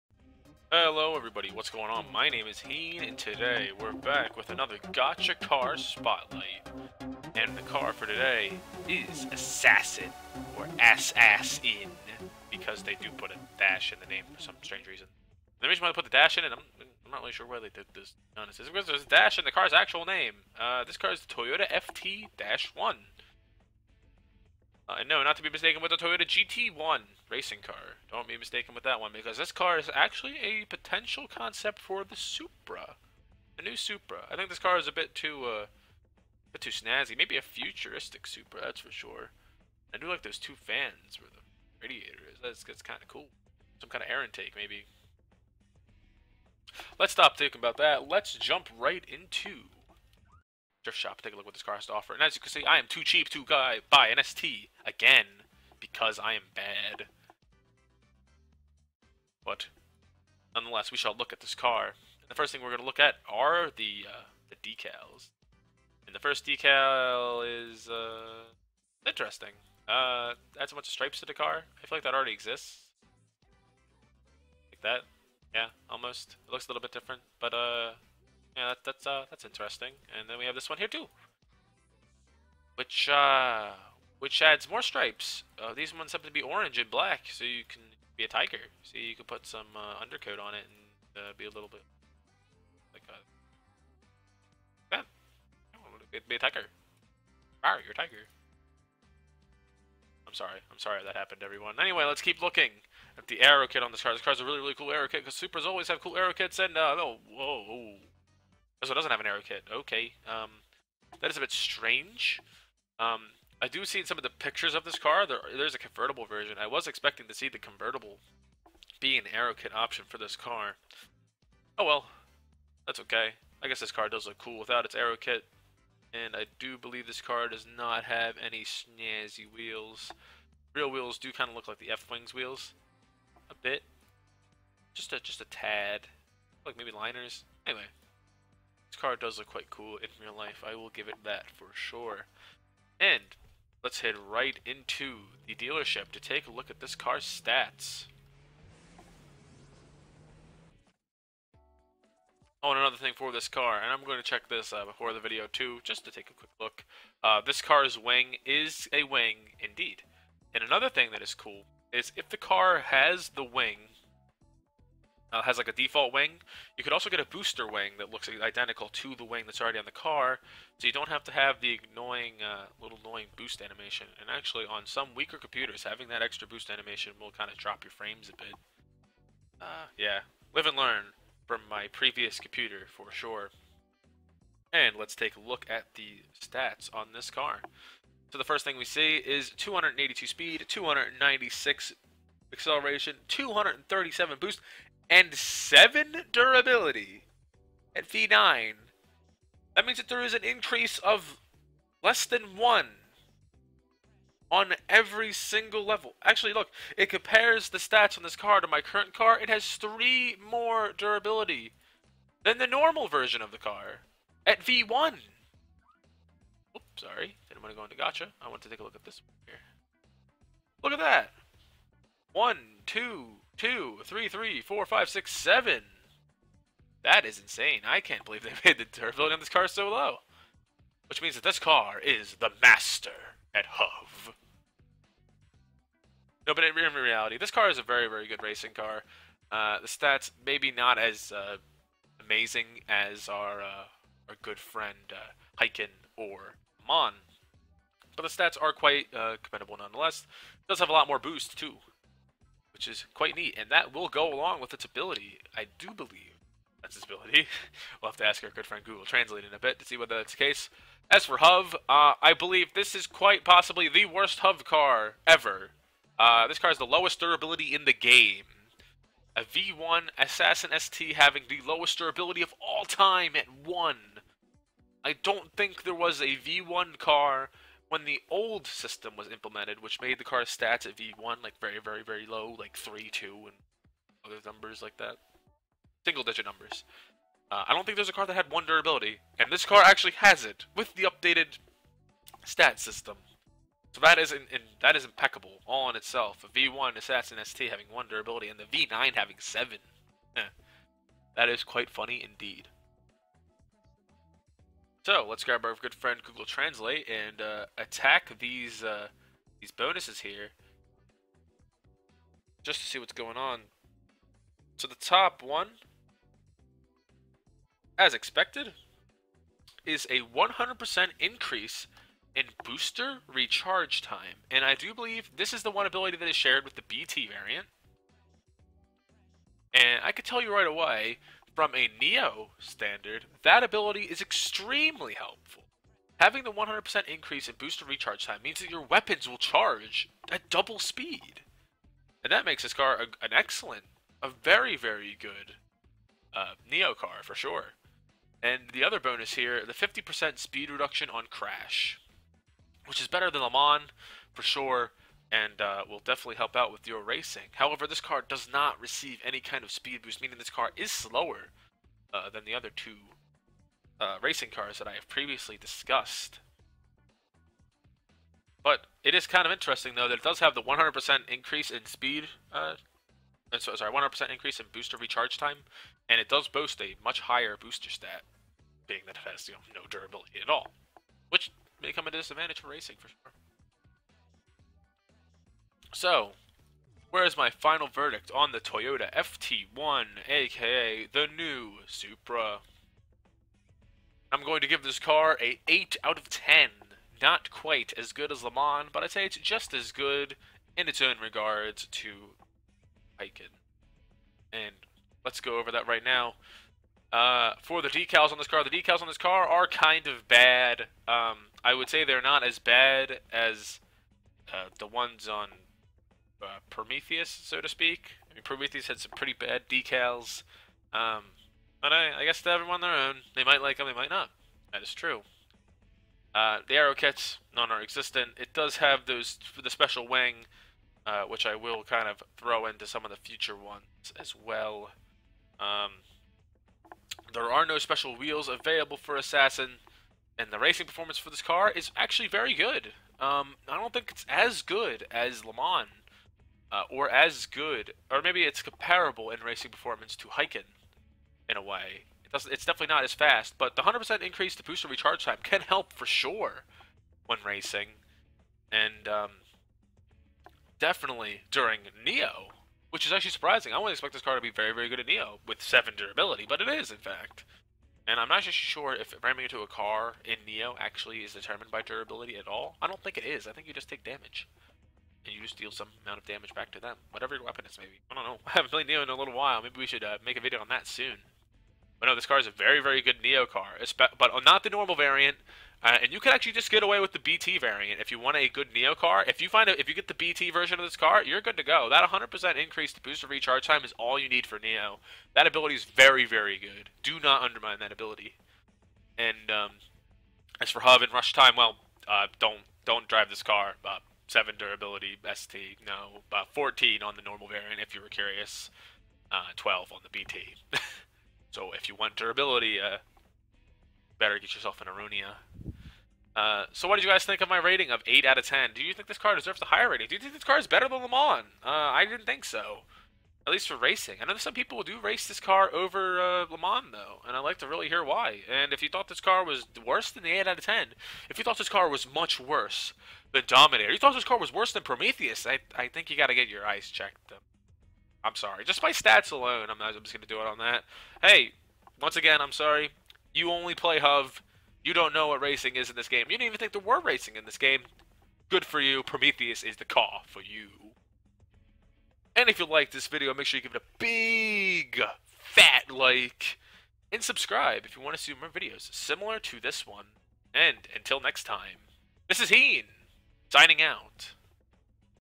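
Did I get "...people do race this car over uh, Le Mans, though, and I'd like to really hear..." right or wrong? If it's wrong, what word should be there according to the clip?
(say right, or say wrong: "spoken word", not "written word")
right.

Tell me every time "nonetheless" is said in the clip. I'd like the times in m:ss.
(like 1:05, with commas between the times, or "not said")
1:00, 4:09.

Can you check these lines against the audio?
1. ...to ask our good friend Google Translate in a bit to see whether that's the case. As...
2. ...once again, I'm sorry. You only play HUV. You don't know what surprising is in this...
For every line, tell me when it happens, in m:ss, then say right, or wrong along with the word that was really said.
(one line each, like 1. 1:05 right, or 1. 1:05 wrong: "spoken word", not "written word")
1. 4:18 right
2. 9:01 wrong: "racing", not "surprising".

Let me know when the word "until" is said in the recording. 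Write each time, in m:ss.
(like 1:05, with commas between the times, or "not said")
9:20.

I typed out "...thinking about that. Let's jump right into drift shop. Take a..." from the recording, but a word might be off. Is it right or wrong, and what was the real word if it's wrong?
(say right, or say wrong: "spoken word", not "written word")
right.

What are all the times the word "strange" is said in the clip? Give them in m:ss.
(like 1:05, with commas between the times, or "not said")
0:14, 1:51.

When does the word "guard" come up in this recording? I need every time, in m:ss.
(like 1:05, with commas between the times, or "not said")
not said.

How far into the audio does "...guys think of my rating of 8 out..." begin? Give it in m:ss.
8:37.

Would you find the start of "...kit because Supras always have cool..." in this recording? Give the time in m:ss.
1:45.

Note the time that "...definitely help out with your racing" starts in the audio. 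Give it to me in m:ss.
5:56.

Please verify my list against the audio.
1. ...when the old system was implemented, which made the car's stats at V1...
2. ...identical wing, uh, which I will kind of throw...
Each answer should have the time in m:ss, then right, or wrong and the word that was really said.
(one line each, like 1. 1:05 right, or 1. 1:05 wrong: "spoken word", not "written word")
1. 4:37 right
2. 7:09 wrong: "special", not "identical".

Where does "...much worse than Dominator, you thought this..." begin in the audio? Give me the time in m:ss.
8:52.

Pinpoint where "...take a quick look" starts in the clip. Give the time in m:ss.
2:36.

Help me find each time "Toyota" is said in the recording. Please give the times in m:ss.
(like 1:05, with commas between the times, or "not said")
0:21, 0:25, 6:28.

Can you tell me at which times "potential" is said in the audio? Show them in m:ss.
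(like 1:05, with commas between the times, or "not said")
0:30.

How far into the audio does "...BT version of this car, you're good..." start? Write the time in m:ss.
8:10.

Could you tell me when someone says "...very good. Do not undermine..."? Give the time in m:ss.
8:16.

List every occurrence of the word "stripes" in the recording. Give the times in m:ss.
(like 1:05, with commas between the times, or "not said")
1:10, 1:24.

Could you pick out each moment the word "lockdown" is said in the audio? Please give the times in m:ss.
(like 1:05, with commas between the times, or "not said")
not said.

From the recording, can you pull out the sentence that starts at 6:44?
And let's go over that right now.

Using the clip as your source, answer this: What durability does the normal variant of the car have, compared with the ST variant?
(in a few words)
14.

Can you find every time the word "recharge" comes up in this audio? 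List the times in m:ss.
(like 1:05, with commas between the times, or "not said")
5:23, 5:37, 6:14, 7:34, 8:13.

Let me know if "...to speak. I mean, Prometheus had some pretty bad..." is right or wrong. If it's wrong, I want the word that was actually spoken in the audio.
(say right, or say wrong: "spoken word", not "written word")
right.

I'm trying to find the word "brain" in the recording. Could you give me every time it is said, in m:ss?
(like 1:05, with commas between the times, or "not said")
not said.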